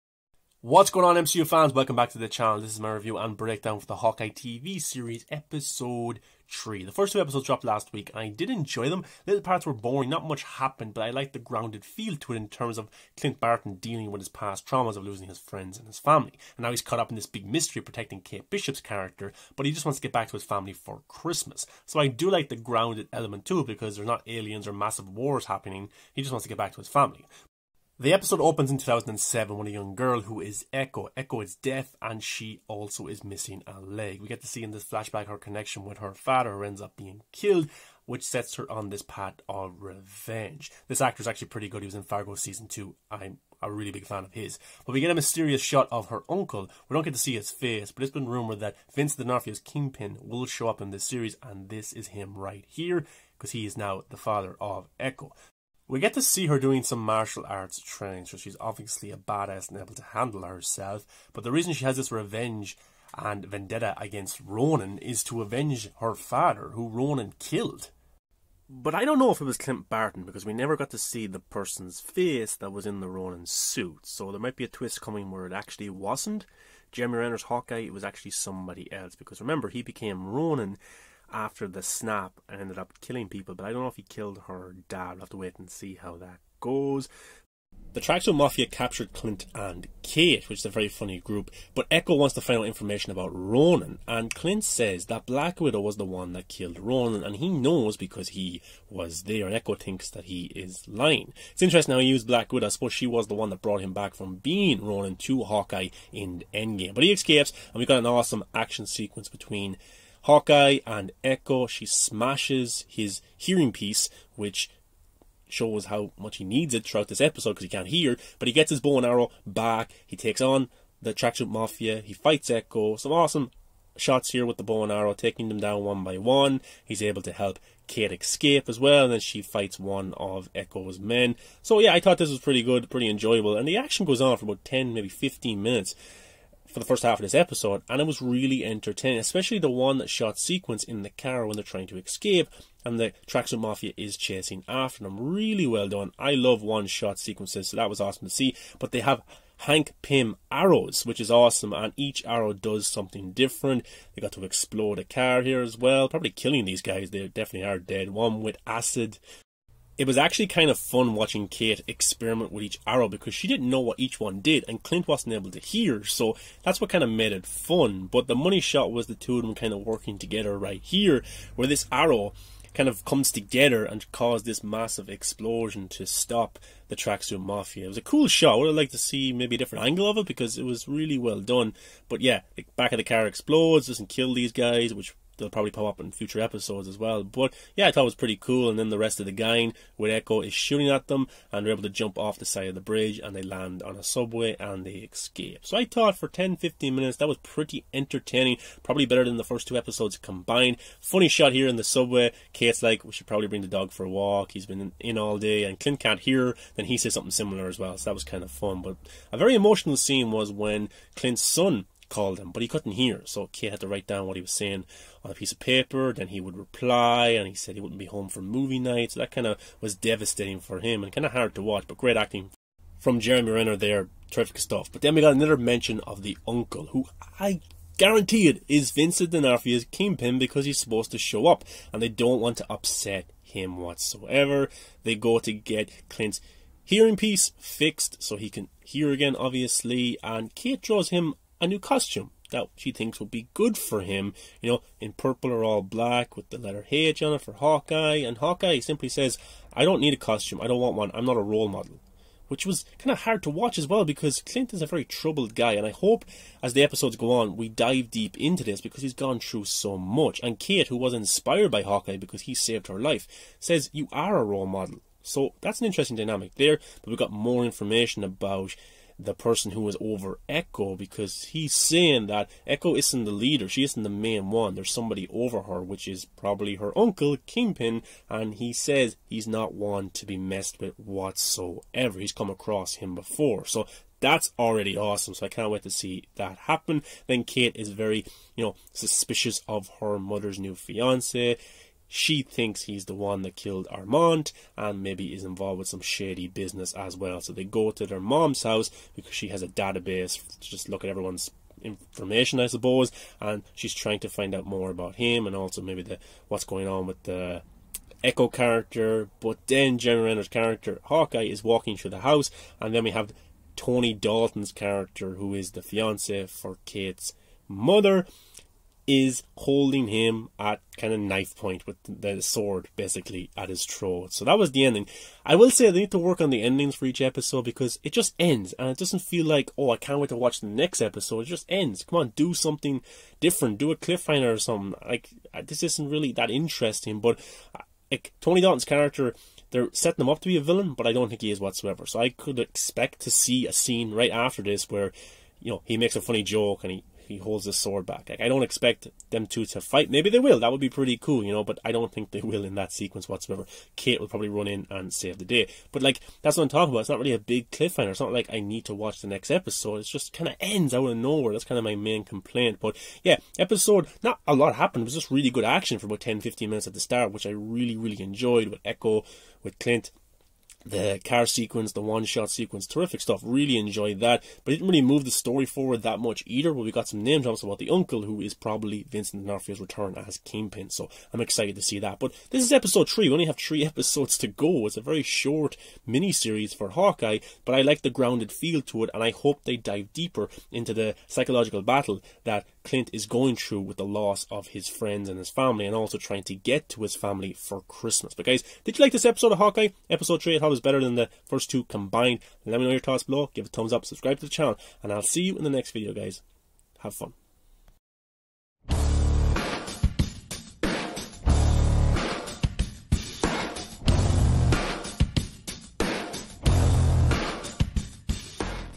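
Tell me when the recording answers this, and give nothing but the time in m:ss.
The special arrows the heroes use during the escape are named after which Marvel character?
2:29.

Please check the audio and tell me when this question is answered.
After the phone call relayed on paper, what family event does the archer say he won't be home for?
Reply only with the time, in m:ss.
3:38.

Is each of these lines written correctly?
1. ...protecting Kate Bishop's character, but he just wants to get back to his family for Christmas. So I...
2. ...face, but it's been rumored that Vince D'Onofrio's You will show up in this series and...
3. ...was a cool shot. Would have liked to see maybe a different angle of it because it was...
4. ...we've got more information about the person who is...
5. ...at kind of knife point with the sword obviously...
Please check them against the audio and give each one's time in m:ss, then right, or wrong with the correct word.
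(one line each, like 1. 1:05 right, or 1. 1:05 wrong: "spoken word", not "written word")
1. 0:17 right
2. 0:47 wrong: "Kingpin", not "You"
3. 2:57 right
4. 4:27 right
5. 5:20 wrong: "basically", not "obviously".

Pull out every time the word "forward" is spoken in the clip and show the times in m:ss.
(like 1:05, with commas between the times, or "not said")
6:15.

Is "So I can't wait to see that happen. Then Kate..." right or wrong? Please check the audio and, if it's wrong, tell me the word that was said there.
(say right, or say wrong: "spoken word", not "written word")
right.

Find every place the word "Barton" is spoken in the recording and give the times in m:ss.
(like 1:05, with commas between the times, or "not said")
0:13, 1:09.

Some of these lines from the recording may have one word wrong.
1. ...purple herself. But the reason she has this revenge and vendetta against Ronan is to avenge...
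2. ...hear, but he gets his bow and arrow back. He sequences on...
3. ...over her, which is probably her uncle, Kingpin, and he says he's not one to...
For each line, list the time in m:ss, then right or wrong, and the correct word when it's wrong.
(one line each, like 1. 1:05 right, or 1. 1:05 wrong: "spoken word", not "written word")
1. 1:00 wrong: "handle", not "purple"
2. 1:57 wrong: "takes", not "sequences"
3. 4:35 right.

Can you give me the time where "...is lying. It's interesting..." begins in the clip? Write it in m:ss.
1:40.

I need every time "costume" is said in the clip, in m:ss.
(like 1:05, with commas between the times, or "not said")
4:01, 4:10.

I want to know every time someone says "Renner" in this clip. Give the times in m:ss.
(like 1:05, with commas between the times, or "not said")
1:17, 3:43, 5:10.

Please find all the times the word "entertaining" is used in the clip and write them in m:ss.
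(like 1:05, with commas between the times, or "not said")
2:18, 3:17.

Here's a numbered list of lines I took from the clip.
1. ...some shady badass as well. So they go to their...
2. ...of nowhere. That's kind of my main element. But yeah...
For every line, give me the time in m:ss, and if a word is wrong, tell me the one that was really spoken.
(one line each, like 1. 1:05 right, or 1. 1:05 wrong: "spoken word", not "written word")
1. 4:55 wrong: "business", not "badass"
2. 6:01 wrong: "complaint", not "element".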